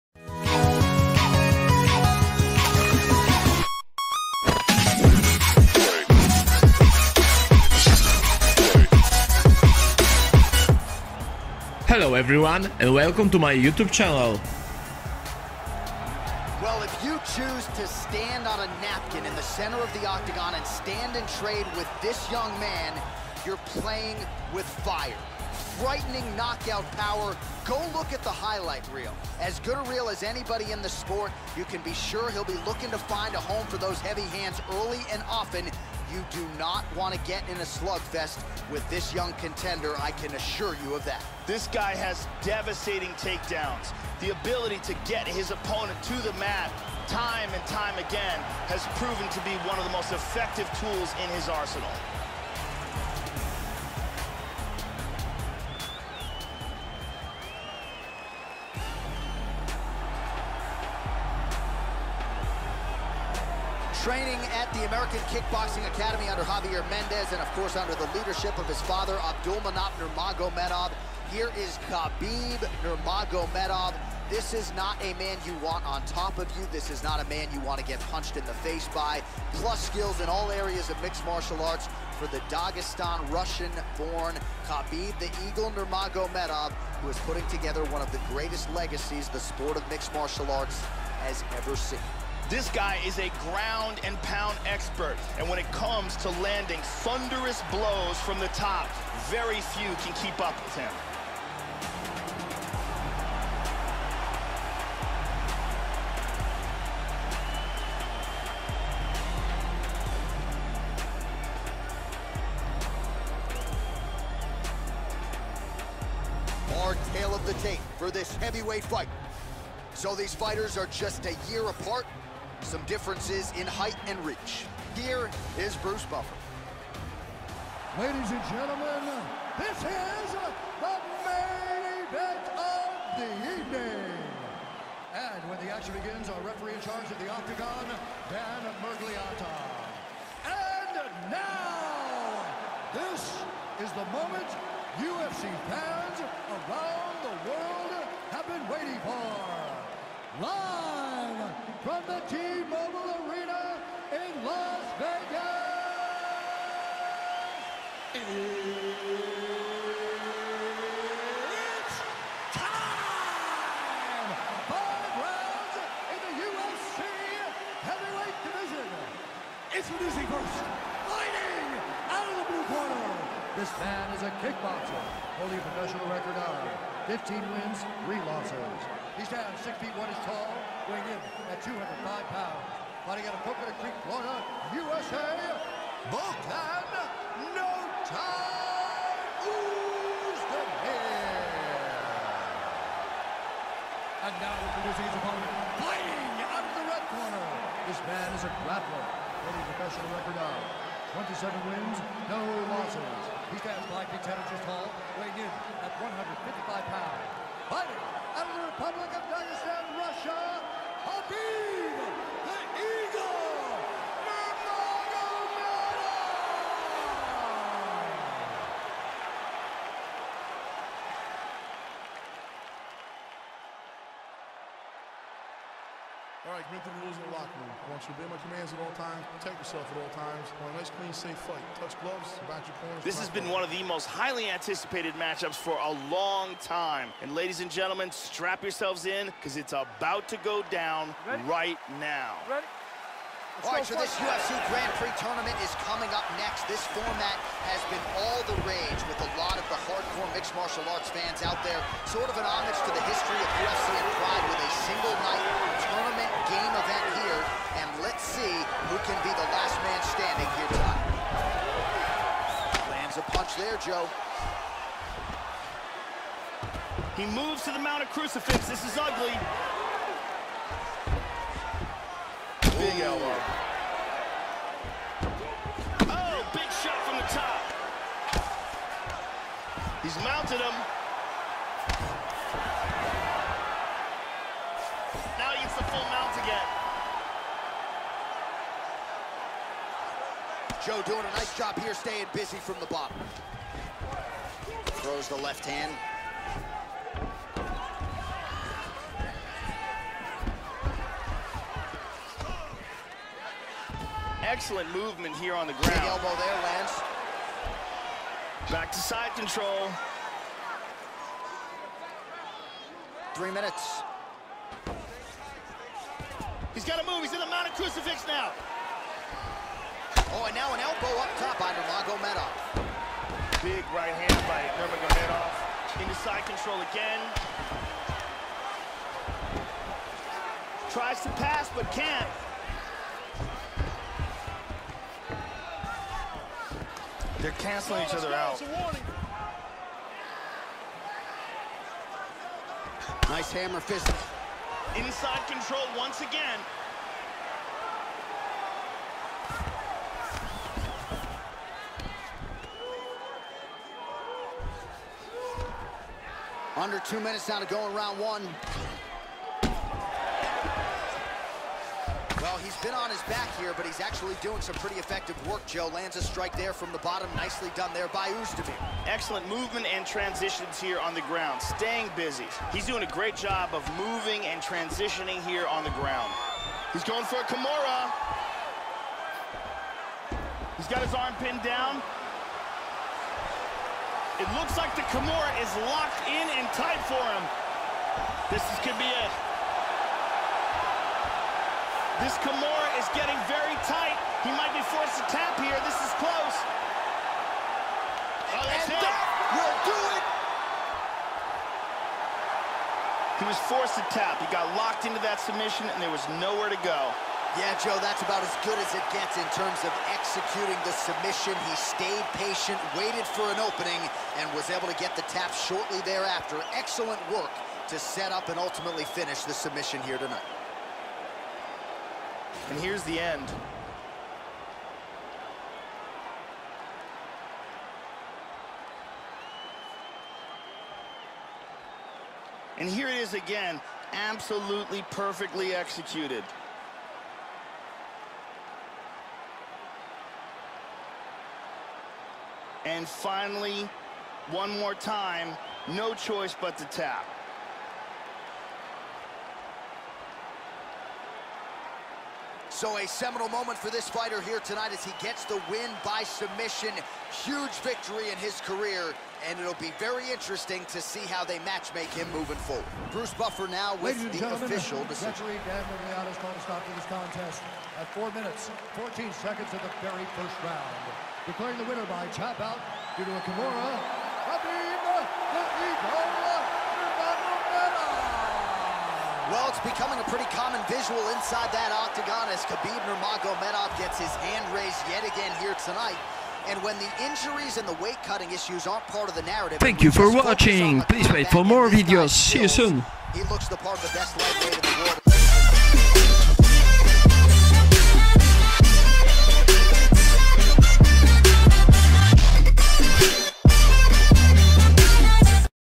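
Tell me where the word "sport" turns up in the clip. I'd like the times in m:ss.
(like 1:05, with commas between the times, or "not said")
0:30, 1:29.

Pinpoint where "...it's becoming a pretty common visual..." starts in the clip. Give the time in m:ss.
7:59.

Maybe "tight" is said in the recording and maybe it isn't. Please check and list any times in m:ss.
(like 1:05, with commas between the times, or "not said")
6:26, 6:33.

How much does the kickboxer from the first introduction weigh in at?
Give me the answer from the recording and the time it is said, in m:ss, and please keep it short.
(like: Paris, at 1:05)
205 pounds, at 3:01.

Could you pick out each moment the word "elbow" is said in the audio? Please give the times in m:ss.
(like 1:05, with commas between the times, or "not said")
4:33, 5:06, 5:20.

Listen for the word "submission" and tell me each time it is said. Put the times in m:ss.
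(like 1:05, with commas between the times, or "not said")
6:45, 6:50, 6:59, 7:36.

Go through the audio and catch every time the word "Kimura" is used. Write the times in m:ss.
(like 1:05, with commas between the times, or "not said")
6:17, 6:25, 6:32, 7:53.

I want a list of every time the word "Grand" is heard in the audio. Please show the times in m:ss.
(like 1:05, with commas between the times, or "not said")
4:04.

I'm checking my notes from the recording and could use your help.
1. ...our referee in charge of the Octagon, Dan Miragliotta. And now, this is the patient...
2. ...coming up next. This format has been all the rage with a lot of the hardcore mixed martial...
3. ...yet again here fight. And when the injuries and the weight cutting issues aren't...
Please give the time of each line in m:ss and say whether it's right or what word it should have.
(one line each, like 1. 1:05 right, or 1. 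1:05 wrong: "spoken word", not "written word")
1. 2:16 wrong: "moment", not "patient"
2. 4:05 right
3. 8:05 wrong: "tonight", not "fight".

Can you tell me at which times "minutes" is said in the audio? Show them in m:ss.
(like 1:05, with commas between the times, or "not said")
5:13, 5:57, 7:48.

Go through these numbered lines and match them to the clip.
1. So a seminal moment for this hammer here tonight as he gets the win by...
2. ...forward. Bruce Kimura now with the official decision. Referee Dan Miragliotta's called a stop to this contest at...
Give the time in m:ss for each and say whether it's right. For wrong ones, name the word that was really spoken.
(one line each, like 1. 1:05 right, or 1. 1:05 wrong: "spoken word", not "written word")
1. 7:32 wrong: "fighter", not "hammer"
2. 7:42 wrong: "Buffer", not "Kimura".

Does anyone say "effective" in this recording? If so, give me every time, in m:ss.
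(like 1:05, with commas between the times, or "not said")
0:50, 6:04.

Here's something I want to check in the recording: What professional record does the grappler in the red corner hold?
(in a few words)
27 wins, no losses.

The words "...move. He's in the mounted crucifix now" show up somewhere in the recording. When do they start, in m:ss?
5:17.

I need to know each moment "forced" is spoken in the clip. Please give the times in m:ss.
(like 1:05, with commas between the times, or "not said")
6:34, 6:43.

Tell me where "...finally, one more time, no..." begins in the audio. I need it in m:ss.
7:23.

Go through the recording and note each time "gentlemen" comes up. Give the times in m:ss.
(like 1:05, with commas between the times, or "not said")
2:08, 3:57.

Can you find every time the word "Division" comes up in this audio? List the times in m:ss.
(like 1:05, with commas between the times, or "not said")
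2:48.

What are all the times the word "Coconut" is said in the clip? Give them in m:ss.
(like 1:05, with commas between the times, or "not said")
3:03.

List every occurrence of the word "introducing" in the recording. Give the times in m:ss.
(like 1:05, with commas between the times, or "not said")
2:49, 3:14.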